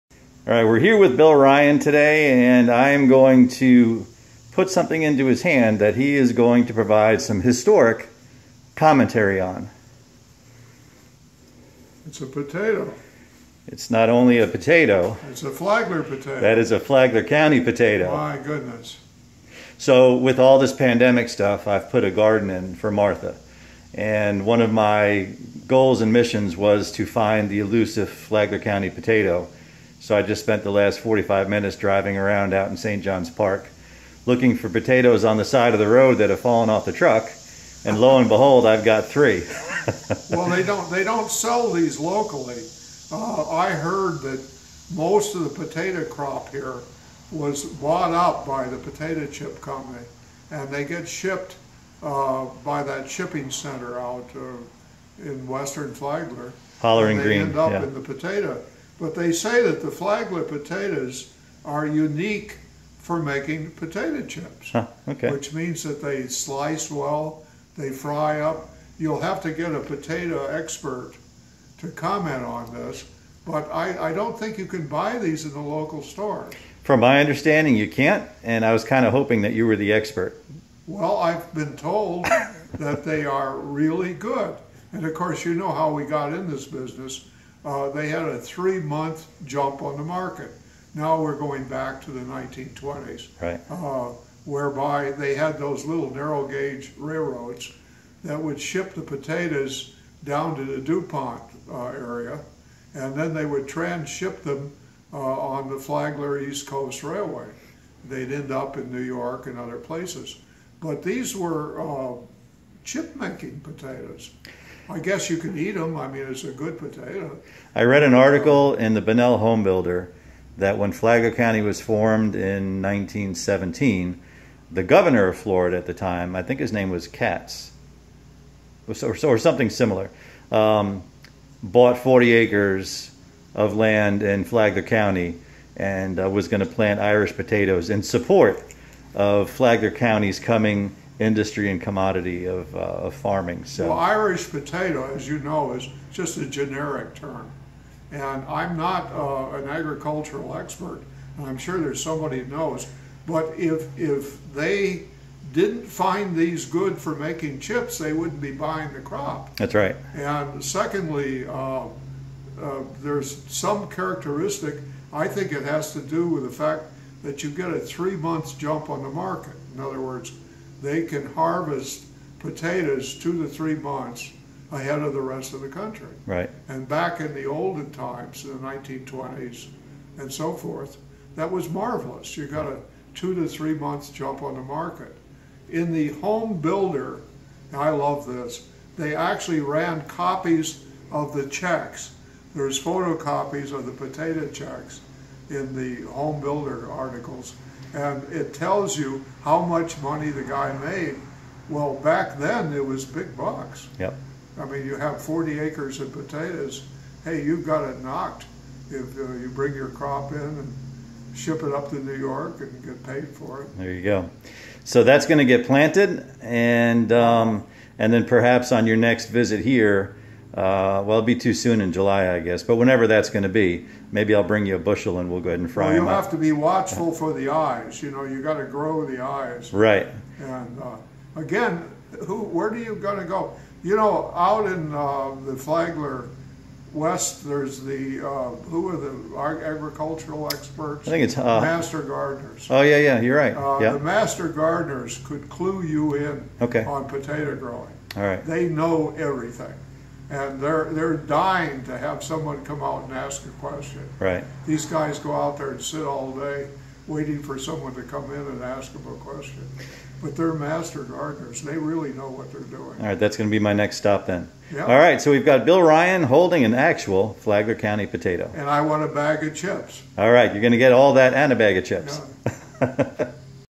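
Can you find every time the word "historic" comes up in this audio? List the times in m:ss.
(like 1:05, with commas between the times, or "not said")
0:07.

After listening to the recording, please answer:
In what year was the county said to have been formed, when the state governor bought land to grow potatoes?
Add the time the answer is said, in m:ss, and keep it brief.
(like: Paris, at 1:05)
1917, at 2:02.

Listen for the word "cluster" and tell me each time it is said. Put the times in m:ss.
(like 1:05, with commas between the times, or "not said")
not said.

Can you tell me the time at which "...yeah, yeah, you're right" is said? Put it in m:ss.
4:02.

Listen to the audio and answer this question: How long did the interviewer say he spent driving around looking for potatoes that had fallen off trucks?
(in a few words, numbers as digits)
45 minutes.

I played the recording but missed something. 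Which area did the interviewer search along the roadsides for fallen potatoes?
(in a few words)
St. John's Park.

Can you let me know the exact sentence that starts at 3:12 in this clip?
There's photocopies of the potato checks in the home builder articles, and it tells you how much money the guy made.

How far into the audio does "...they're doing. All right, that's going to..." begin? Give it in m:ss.
4:22.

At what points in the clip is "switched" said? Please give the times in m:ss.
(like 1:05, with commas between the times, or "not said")
not said.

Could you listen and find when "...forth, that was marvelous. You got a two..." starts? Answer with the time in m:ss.
3:00.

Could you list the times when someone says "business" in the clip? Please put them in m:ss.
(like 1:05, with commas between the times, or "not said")
1:26.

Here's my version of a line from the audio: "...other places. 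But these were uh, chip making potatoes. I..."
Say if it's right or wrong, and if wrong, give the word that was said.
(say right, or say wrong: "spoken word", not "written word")
right.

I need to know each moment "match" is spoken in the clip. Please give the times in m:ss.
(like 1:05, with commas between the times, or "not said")
not said.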